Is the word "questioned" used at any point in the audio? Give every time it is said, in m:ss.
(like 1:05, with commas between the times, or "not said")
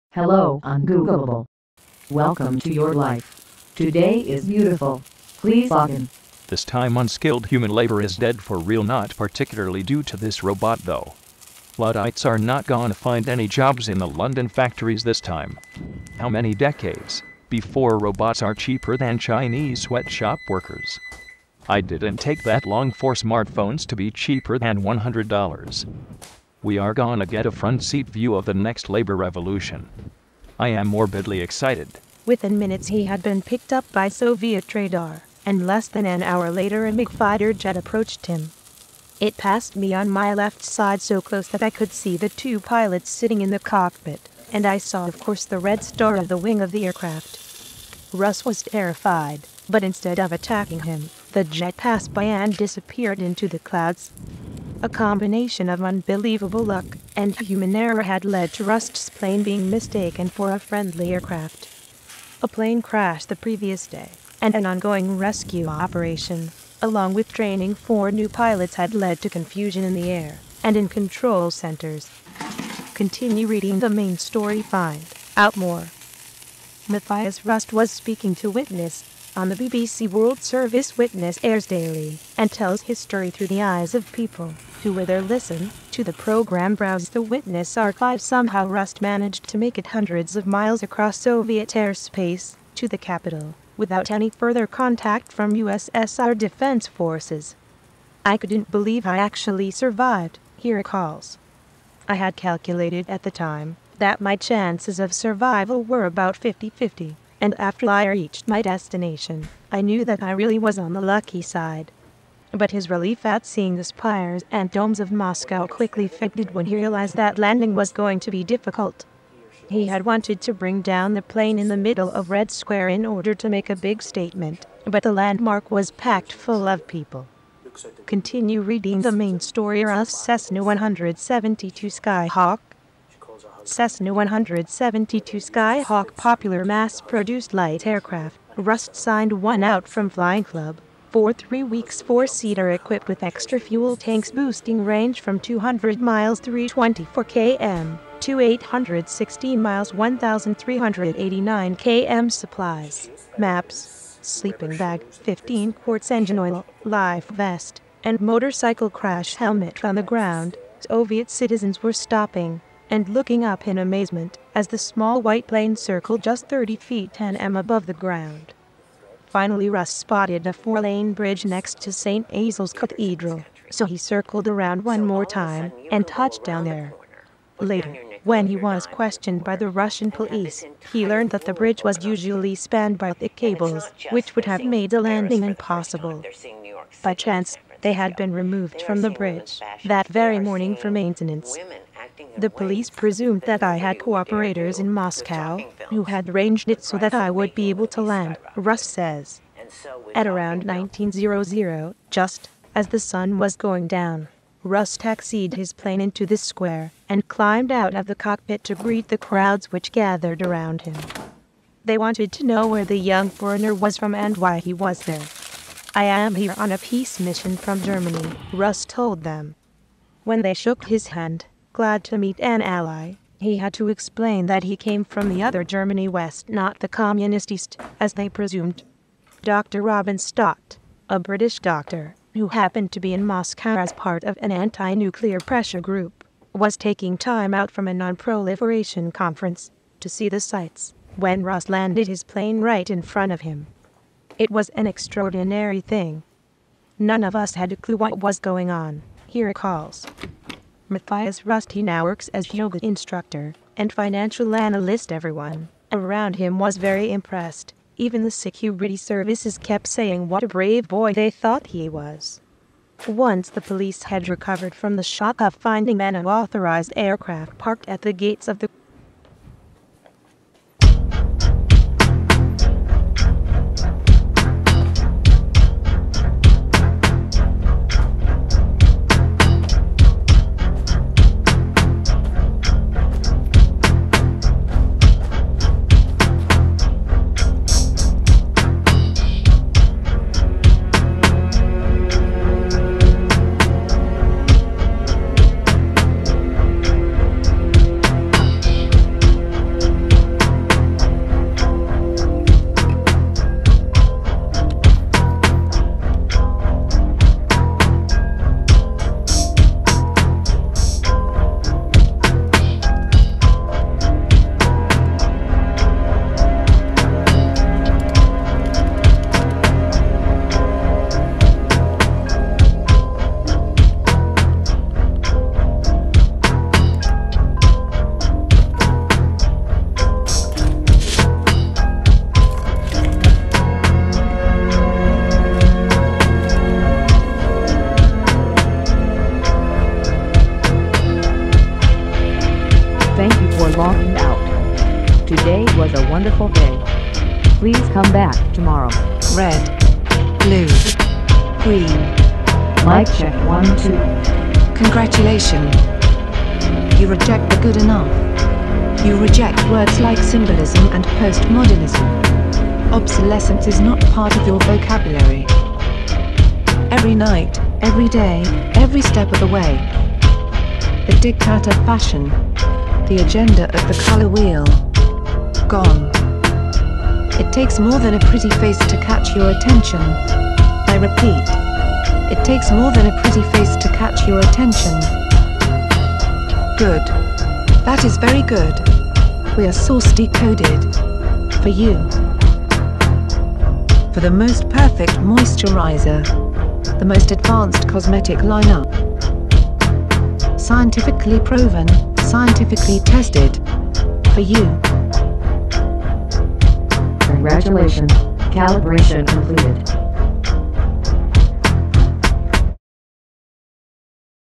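2:58.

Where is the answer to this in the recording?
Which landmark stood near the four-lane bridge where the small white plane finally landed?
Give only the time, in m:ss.
2:51.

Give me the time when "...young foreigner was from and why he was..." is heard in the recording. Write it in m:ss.
3:32.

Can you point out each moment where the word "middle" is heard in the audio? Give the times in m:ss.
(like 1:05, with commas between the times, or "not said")
2:01.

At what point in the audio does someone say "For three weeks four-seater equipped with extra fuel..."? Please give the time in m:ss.
2:21.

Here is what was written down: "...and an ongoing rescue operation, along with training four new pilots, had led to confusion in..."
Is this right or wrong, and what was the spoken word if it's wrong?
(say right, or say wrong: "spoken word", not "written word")
right.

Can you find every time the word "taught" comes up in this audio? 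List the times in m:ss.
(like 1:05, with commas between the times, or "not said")
not said.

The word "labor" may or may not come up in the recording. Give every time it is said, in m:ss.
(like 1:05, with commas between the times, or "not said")
0:07, 0:28.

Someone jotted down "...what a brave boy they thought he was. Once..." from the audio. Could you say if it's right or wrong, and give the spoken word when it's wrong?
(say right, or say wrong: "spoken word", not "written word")
right.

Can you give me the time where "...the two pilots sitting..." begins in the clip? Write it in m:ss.
0:42.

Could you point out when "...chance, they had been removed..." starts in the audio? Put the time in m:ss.
3:07.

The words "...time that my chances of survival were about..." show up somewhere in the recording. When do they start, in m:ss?
1:43.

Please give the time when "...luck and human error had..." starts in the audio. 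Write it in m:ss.
0:56.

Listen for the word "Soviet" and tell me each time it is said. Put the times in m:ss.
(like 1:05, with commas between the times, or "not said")
0:34, 1:31, 2:40.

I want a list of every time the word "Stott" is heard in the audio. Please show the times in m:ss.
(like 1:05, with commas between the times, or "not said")
3:50.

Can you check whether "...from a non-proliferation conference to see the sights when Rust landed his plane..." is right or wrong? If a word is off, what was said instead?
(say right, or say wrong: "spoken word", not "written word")
right.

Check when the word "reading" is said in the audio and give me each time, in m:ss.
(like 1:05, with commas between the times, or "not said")
1:13, 2:08.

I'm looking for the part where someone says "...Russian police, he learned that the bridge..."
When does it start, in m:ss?
2:59.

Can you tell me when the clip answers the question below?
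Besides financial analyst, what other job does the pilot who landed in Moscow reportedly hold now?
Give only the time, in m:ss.
4:12.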